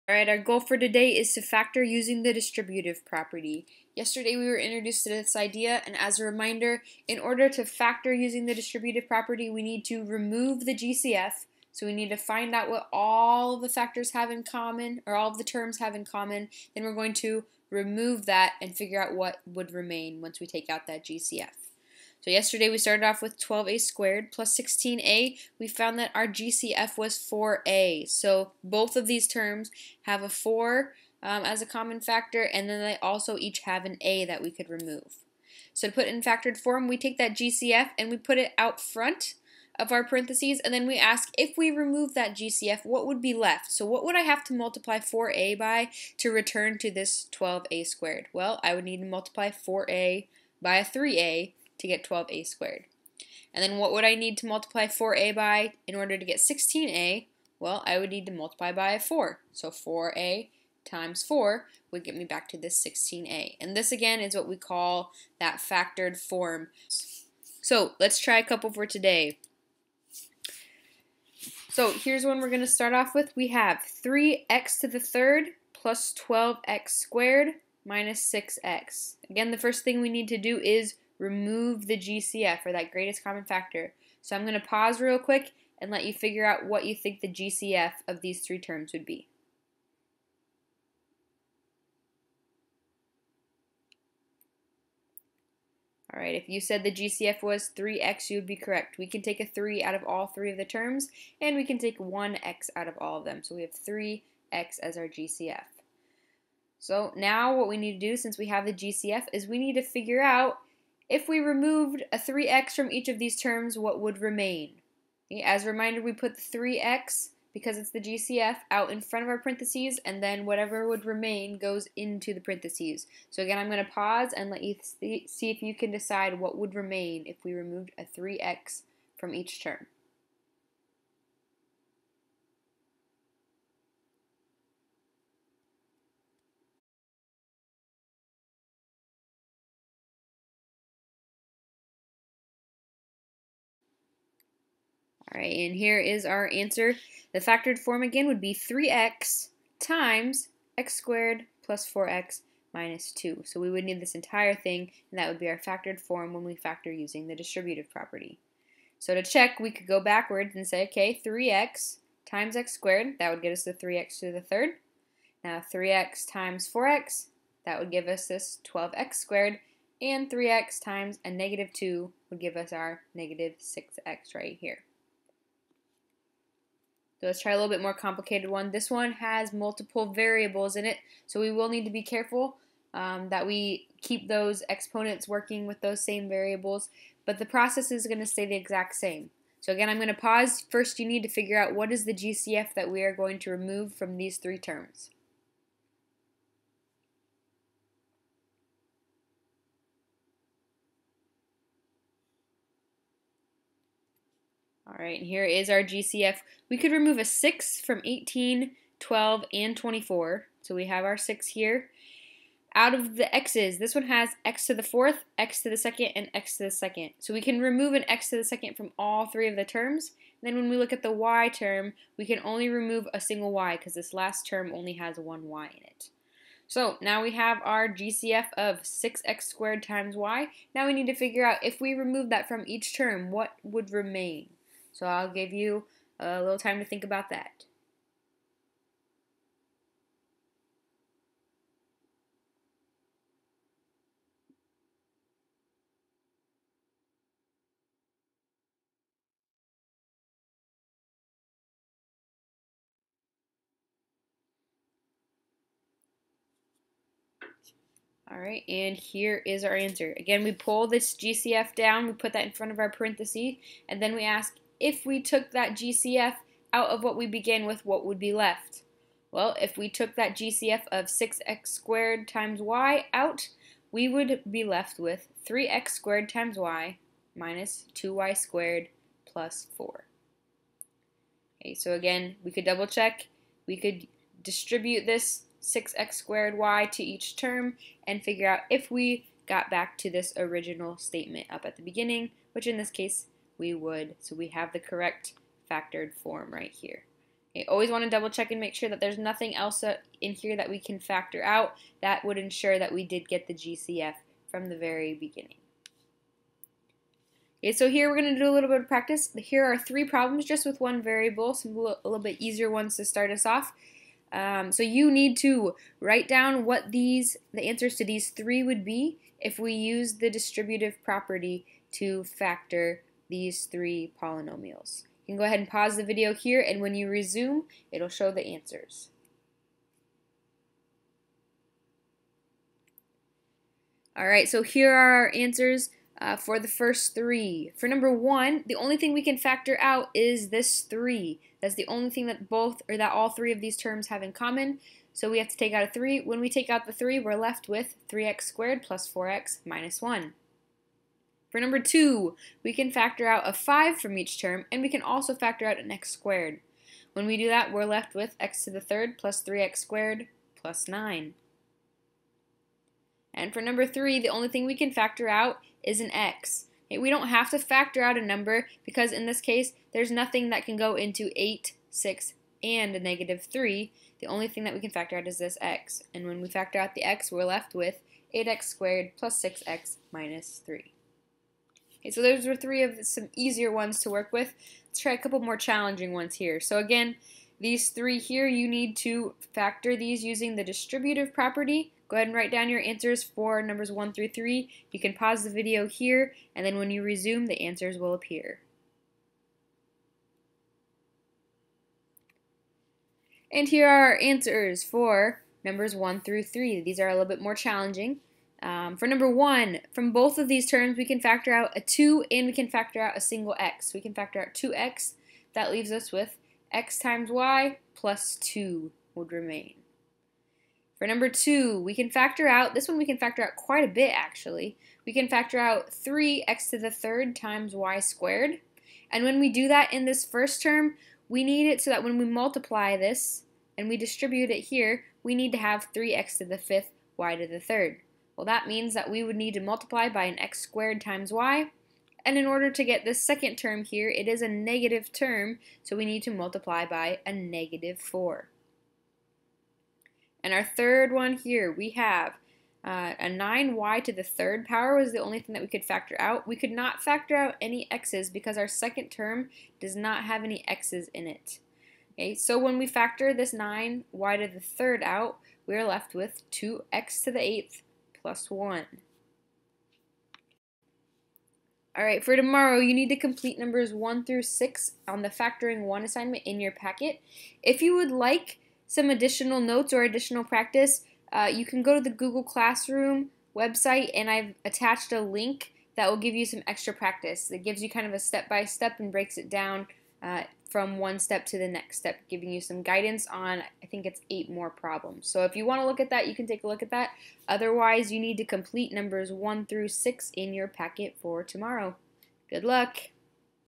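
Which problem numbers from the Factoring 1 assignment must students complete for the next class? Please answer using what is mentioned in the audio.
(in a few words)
1 through 6.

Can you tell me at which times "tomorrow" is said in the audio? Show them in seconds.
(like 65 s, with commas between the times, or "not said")
472 s, 501 s.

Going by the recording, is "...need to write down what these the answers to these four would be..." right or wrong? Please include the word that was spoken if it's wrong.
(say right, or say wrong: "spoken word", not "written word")
wrong: "three", not "four".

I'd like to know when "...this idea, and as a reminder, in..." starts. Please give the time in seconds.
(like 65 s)
5 s.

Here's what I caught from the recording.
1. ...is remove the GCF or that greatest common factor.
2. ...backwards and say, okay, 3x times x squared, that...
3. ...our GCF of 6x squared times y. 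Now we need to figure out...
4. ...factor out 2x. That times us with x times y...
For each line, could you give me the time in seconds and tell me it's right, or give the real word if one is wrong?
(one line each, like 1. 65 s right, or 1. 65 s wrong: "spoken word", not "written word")
1. 80 s right
2. 160 s right
3. 227 s right
4. 414 s wrong: "leaves", not "times".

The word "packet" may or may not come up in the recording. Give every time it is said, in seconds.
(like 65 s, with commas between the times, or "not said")
476 s, 500 s.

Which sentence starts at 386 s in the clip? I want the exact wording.
So again, these three here, you need to factor these using the distributive property.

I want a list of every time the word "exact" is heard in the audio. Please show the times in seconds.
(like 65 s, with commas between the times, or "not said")
188 s.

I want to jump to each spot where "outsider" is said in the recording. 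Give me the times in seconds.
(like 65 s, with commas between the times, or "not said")
not said.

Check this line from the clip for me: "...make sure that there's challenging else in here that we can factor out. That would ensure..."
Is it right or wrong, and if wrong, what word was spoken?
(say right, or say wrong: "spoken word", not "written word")
wrong: "nothing", not "challenging".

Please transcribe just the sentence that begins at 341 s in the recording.
That's the only thing that both, or that all three of these terms have in common.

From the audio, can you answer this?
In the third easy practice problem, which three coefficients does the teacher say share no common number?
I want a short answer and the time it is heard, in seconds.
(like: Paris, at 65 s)
8, 6, and -3, at 371 s.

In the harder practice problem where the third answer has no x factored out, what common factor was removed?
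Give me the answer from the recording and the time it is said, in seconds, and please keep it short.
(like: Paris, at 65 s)
9y^3, at 453 s.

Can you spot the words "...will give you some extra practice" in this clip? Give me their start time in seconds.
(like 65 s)
486 s.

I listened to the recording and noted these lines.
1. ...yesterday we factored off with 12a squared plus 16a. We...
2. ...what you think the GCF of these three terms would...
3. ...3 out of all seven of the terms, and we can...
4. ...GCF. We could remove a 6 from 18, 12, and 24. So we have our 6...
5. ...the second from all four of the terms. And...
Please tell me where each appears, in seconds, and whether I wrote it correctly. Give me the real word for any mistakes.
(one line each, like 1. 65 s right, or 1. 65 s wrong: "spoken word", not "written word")
1. 22 s wrong: "started", not "factored"
2. 86 s right
3. 99 s wrong: "three", not "seven"
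4. 205 s right
5. 218 s wrong: "three", not "four".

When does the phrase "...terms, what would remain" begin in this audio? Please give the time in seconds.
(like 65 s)
113 s.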